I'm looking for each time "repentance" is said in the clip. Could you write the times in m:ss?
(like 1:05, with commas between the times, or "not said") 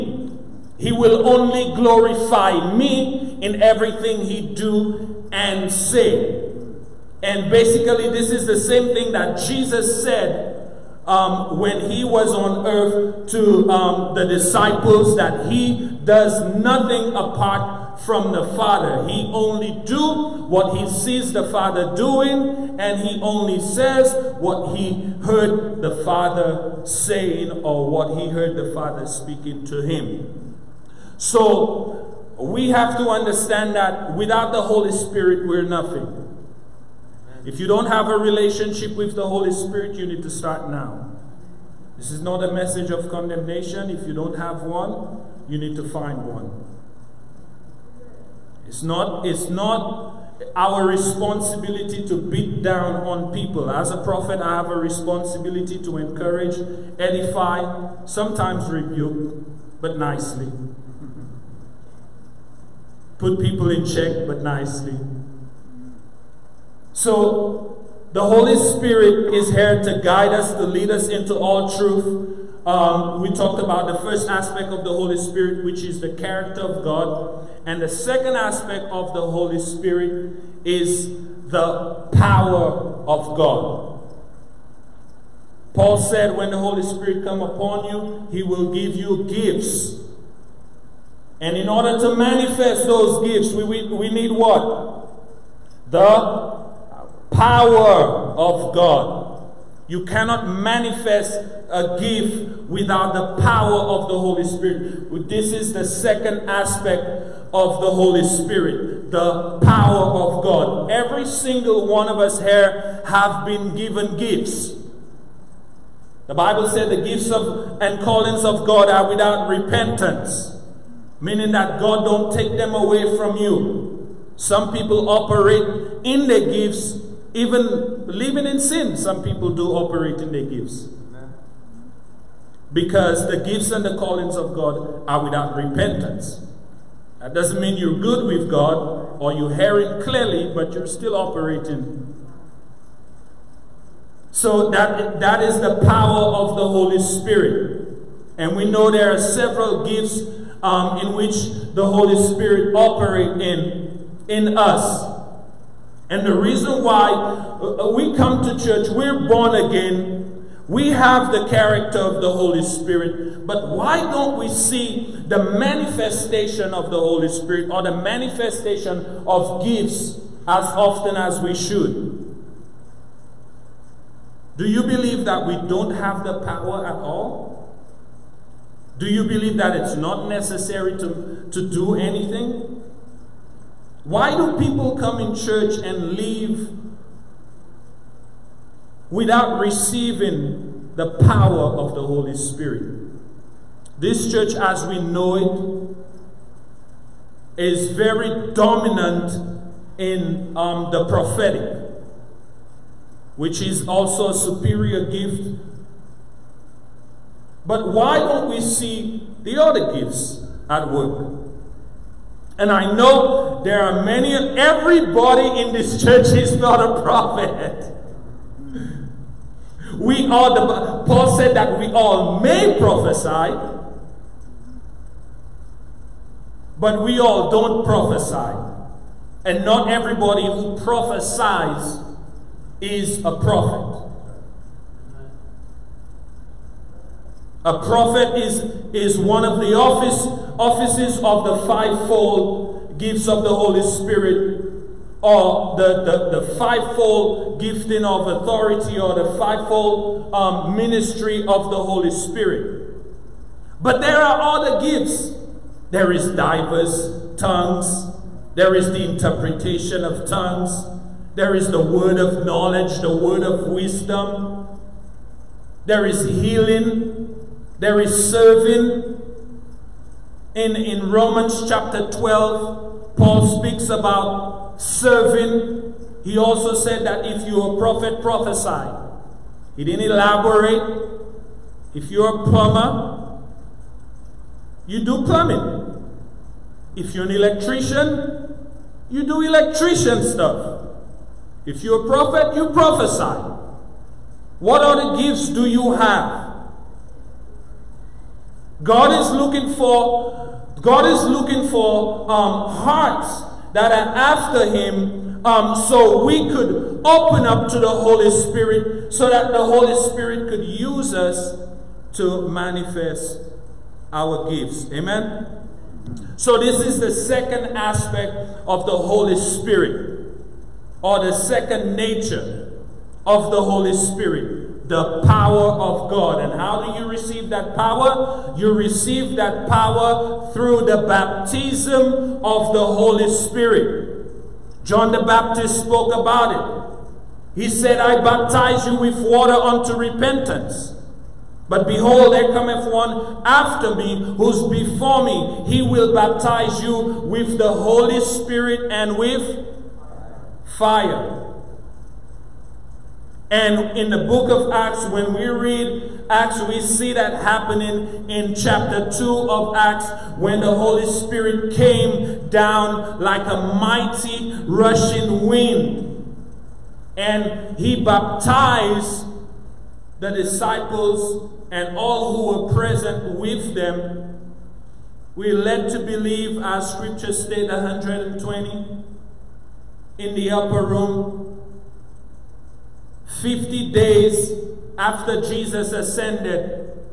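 1:59, 2:15, 5:39.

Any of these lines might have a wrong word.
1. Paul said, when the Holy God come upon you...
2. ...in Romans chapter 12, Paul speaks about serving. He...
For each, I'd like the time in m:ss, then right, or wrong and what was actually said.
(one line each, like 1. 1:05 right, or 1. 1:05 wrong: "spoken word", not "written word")
1. 1:25 wrong: "Spirit", not "God"
2. 4:30 right.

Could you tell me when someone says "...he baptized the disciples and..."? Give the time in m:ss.
6:07.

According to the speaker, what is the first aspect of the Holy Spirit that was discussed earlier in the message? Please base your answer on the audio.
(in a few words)
The character of God.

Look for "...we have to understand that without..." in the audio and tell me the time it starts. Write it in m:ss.
0:32.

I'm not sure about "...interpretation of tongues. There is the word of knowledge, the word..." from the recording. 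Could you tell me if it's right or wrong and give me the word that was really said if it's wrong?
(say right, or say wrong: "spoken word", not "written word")
right.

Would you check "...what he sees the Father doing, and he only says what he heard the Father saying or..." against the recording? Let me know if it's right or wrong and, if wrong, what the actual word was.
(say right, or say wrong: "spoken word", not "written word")
right.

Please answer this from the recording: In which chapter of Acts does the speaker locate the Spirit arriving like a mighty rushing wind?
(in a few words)
Chapter 2.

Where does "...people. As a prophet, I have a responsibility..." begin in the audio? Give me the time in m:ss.
0:53.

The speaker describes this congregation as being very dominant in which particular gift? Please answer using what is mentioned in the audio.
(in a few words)
The prophetic.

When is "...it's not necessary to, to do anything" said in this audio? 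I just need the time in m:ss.
2:59.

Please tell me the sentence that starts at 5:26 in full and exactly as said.
And how do you receive that power?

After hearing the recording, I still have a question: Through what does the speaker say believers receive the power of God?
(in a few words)
Baptism of the Holy Spirit.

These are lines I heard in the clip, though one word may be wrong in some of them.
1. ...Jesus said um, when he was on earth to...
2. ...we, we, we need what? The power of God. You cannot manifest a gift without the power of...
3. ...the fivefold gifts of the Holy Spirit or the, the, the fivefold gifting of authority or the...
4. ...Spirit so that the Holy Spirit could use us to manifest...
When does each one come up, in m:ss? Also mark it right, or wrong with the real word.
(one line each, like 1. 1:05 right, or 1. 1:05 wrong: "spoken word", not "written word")
1. 0:09 right
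2. 1:33 right
3. 4:01 right
4. 5:08 right.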